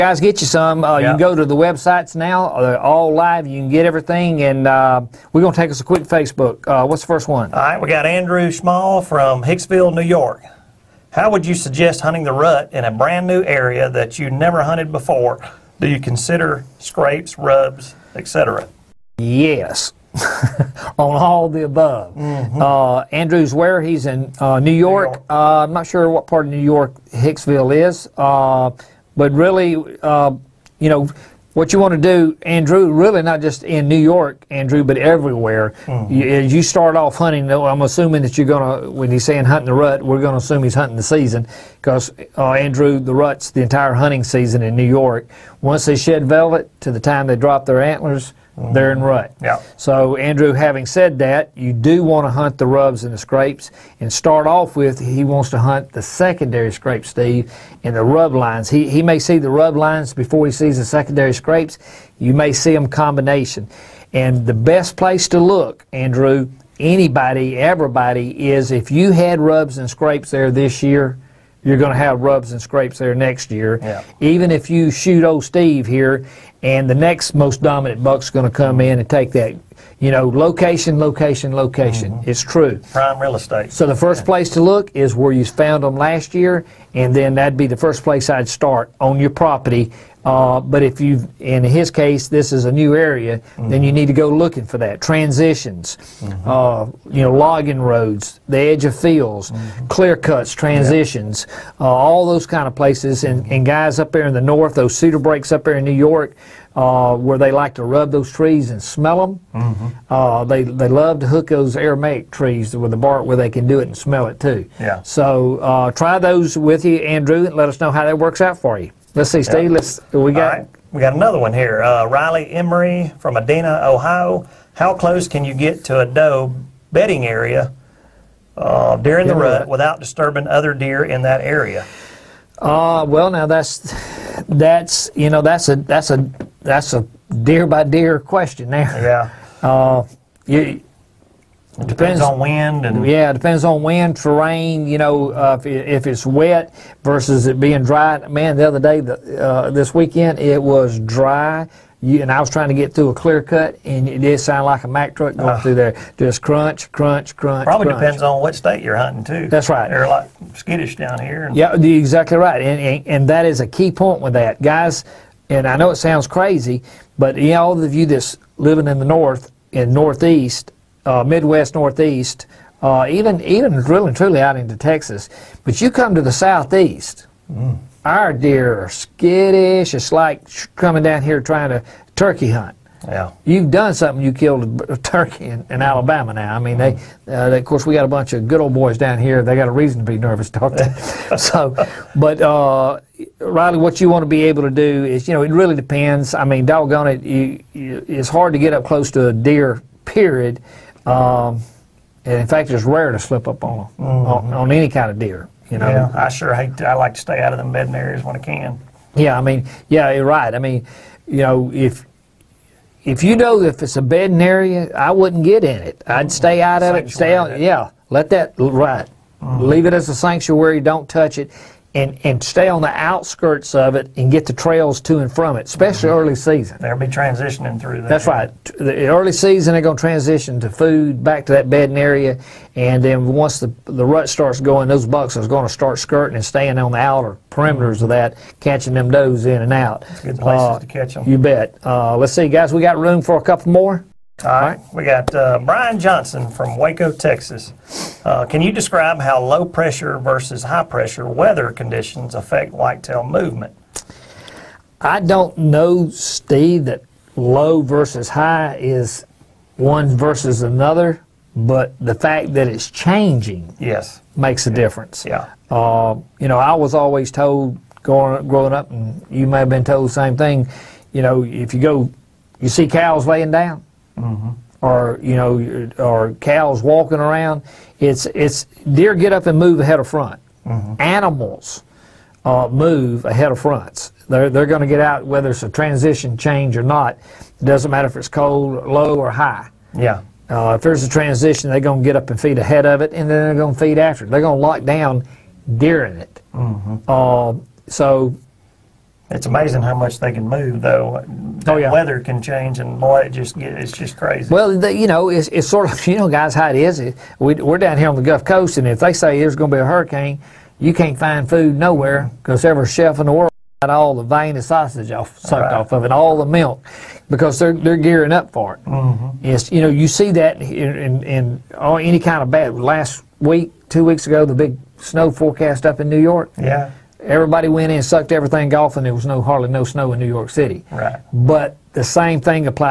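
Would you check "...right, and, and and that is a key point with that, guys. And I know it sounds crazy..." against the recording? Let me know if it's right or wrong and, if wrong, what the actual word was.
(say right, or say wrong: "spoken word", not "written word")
right.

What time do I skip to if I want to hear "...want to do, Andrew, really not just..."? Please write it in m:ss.
0:31.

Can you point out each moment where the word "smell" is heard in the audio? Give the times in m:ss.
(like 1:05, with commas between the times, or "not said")
1:48, 1:53.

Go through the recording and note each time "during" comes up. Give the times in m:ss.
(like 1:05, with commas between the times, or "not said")
2:08, 4:55.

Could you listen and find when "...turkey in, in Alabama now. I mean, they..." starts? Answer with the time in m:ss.
3:04.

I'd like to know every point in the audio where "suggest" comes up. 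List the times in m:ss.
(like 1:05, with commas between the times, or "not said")
0:11.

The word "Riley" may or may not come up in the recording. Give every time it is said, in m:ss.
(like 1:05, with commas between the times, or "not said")
2:02, 3:13.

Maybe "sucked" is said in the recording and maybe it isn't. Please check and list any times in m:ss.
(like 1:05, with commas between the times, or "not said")
5:15, 5:28.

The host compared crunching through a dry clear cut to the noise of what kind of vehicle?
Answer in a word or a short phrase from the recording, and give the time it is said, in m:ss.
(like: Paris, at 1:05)
Mack truck, at 2:34.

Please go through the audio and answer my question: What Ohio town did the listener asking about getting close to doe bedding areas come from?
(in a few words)
Adena.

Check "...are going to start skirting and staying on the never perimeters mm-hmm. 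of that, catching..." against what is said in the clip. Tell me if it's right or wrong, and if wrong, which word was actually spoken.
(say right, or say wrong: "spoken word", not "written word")
wrong: "outer", not "never".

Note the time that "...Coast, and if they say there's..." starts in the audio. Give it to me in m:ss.
5:08.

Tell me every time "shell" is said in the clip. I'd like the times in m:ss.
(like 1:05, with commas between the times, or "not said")
not said.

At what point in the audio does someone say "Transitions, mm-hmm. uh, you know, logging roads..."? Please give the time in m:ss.
1:35.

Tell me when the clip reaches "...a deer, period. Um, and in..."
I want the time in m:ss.
3:19.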